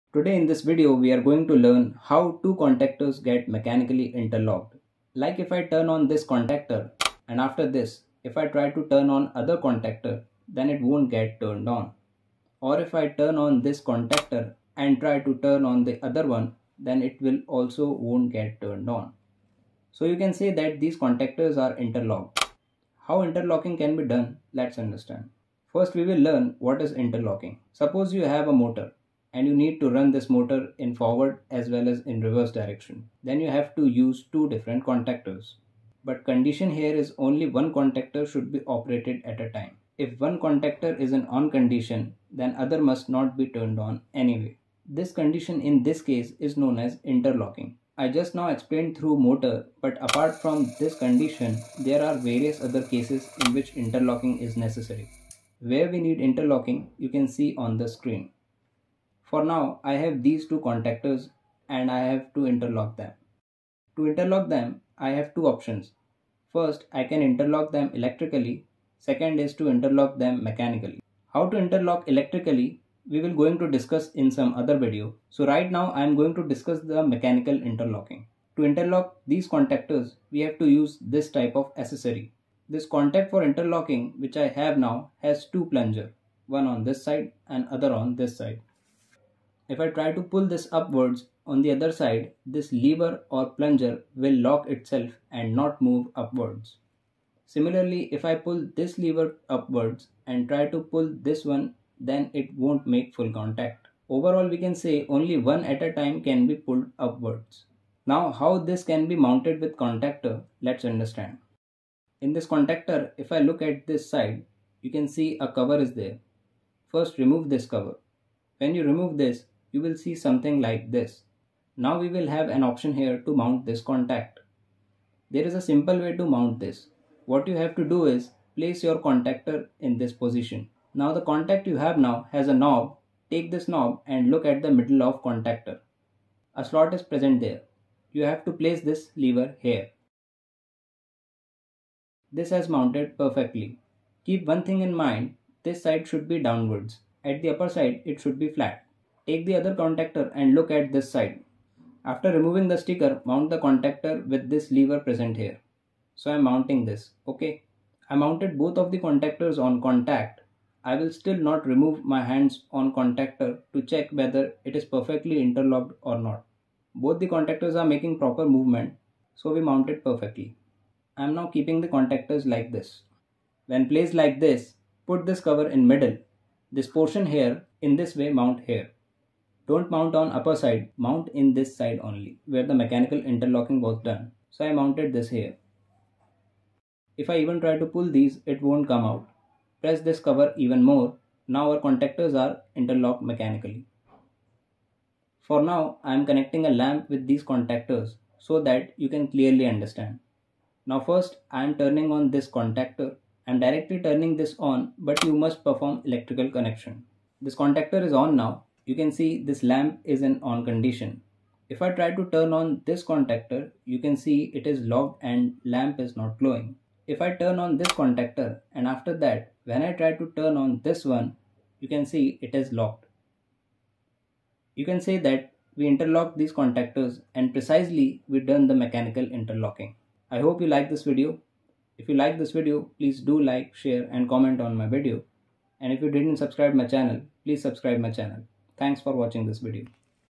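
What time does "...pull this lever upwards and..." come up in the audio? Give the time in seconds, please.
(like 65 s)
98 s.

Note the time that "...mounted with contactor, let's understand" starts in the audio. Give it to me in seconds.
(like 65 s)
109 s.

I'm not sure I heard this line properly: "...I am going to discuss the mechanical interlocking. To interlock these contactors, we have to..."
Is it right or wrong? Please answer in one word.
right.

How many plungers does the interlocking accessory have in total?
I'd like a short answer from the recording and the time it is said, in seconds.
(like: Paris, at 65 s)
2, at 85 s.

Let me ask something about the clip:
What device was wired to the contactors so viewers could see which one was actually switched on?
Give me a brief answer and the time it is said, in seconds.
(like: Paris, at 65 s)
A lamp, at 196 s.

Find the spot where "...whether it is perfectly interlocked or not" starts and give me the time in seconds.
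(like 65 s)
164 s.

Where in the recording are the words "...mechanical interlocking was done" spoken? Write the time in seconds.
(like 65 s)
182 s.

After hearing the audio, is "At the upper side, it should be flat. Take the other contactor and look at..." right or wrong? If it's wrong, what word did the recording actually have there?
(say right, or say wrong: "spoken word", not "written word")
right.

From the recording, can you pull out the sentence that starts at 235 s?
And if you didn't subscribe my channel, please subscribe my channel.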